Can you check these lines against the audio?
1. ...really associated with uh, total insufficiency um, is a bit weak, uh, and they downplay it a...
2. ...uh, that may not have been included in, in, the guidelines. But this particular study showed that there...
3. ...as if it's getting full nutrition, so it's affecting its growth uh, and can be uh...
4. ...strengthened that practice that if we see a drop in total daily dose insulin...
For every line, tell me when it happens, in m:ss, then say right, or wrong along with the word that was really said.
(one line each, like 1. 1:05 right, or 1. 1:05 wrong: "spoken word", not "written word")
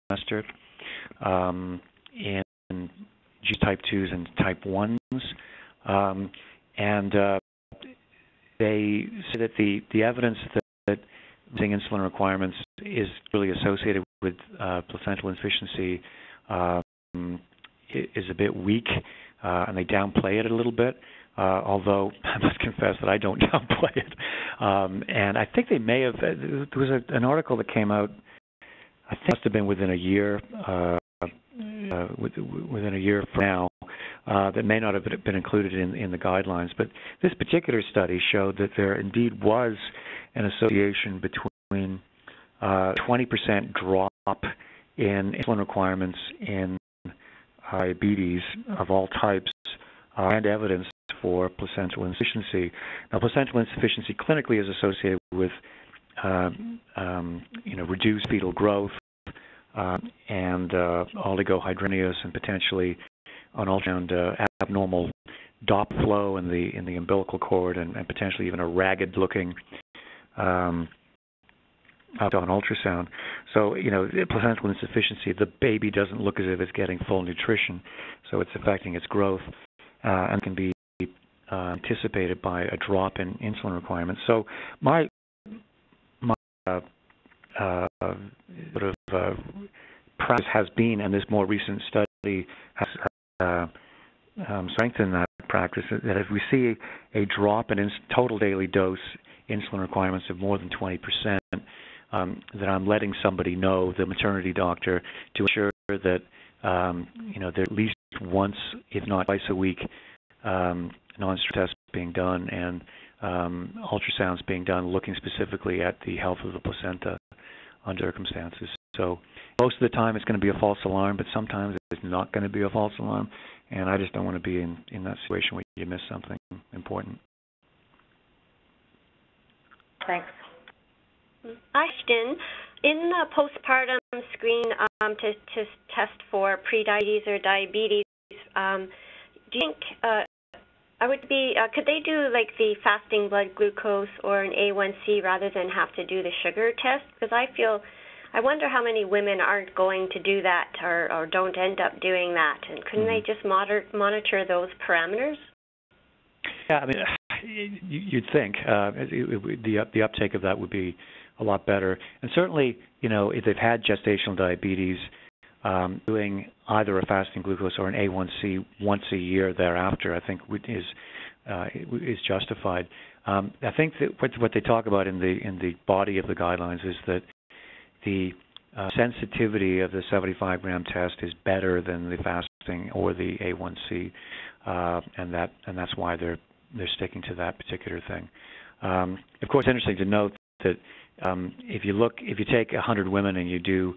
1. 0:13 wrong: "placental", not "total"
2. 0:34 right
3. 1:16 right
4. 1:34 right.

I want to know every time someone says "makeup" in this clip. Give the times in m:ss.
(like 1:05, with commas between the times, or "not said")
not said.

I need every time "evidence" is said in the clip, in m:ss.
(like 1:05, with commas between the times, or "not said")
0:10, 0:50.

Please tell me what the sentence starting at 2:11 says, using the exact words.
Ashton, in the postpartum screen um, to, to test for prediabetes or diabetes, um, do you think uh, I would be?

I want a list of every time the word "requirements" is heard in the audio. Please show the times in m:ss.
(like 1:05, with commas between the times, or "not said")
0:12, 0:45, 1:23, 1:39.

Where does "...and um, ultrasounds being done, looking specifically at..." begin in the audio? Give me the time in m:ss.
1:52.